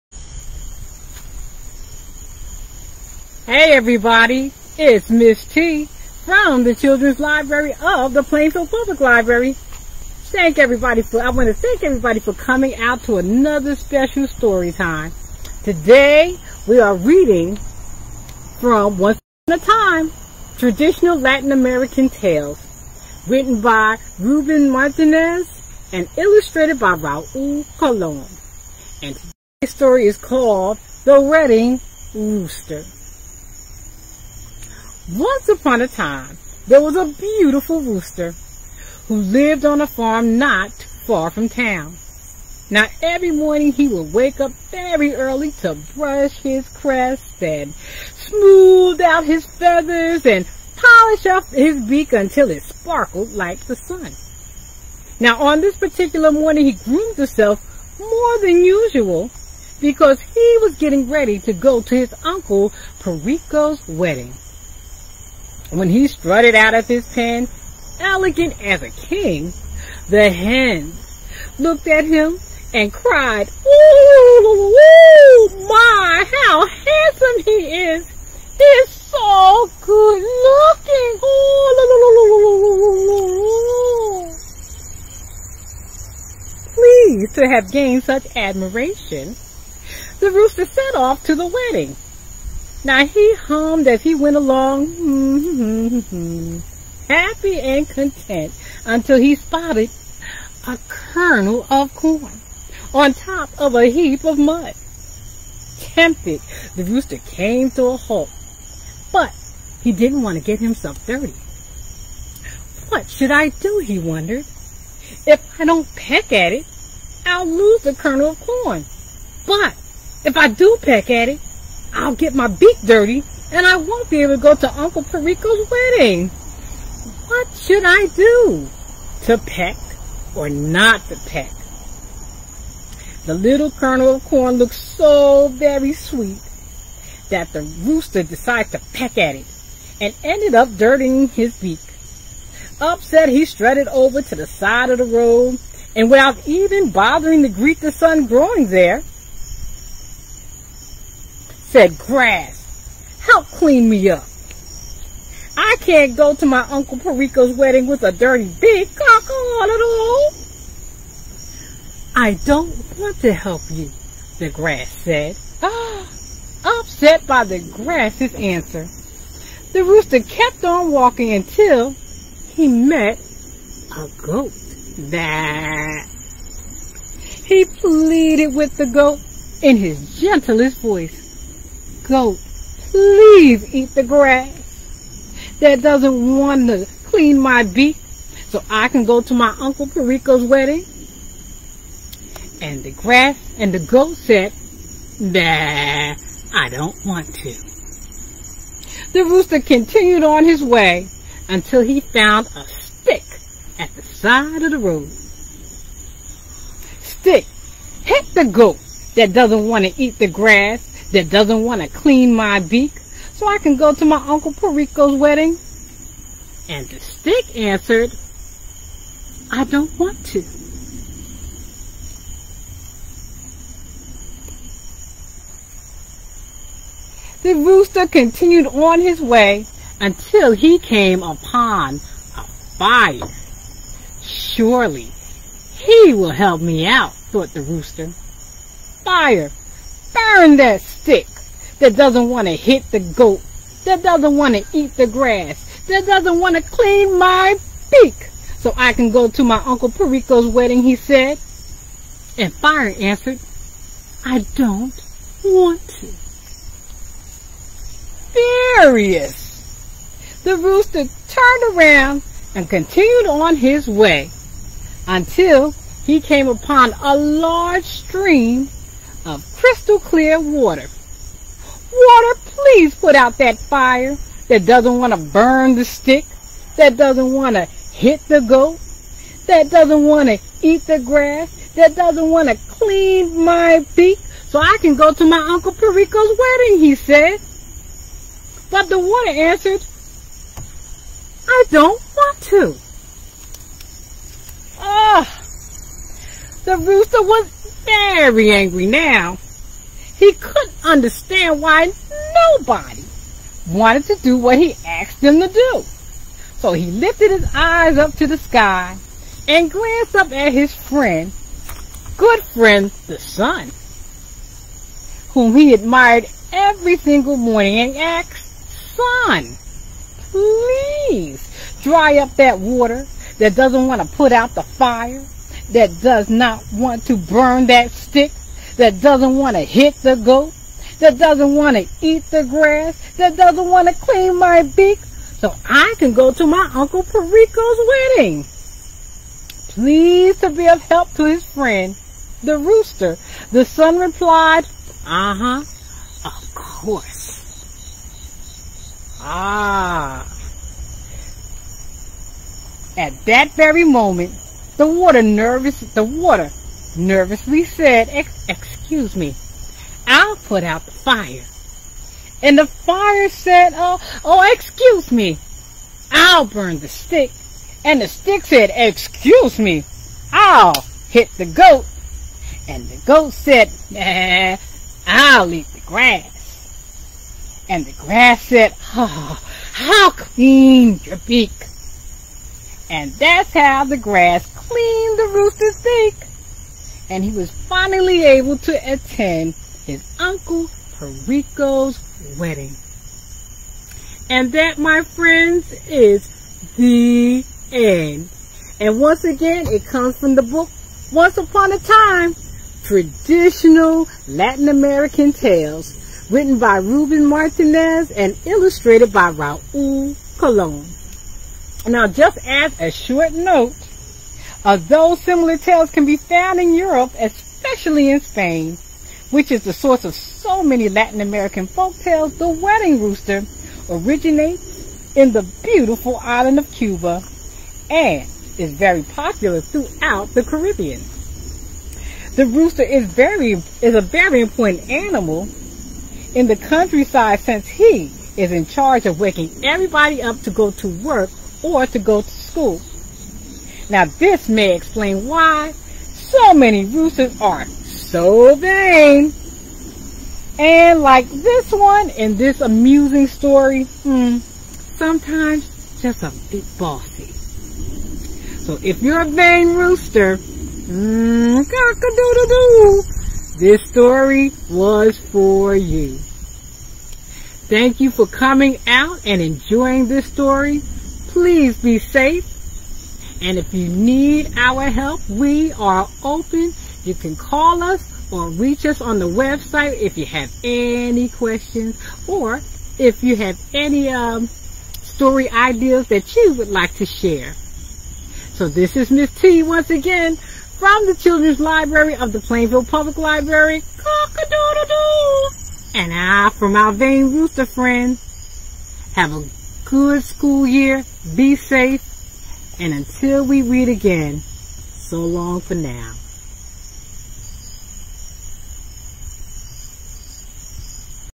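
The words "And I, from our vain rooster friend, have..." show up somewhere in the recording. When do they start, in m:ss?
8:15.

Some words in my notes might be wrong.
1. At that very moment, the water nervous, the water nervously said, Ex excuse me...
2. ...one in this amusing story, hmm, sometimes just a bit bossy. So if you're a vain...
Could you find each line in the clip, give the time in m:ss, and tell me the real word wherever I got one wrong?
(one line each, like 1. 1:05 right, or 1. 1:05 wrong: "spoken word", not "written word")
1. 5:52 right
2. 7:31 right.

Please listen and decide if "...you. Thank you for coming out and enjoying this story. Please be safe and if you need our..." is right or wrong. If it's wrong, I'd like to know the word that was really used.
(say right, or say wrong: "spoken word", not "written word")
right.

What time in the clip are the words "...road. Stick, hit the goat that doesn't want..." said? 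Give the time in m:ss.
3:24.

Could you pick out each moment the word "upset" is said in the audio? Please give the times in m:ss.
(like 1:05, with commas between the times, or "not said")
2:22, 2:46.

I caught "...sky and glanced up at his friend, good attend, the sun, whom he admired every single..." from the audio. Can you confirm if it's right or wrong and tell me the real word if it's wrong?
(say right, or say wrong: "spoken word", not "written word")
wrong: "friend", not "attend".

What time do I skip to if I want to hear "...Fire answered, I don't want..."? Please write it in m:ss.
4:12.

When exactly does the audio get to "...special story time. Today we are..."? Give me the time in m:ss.
0:13.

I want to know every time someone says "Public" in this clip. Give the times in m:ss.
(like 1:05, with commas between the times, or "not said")
0:08, 8:12.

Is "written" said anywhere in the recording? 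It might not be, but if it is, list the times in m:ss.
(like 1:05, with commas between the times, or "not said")
0:23, 6:46.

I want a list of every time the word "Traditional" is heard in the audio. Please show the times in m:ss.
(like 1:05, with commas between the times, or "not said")
0:20, 6:42.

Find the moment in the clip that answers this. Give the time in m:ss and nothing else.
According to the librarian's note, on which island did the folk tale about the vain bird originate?
7:06.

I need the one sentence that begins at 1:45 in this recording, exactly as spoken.
Tempted, the rooster came to a halt, but he didn't want to get himself dirty.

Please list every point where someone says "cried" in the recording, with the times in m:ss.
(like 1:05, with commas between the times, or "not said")
1:12.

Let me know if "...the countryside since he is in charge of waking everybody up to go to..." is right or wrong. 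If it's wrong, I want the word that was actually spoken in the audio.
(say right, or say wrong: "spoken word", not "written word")
right.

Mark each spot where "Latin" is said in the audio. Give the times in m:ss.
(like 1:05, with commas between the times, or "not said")
0:21, 6:44, 7:00.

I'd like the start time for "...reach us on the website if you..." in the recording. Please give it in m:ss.
7:58.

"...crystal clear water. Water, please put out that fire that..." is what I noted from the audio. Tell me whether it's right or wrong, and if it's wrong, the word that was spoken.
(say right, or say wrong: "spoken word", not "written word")
right.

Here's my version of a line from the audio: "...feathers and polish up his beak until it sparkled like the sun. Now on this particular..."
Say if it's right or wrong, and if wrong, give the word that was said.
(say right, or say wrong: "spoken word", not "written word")
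right.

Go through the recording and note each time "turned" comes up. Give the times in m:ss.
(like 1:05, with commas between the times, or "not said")
4:21.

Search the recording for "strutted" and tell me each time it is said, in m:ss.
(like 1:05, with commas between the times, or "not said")
1:06, 2:23.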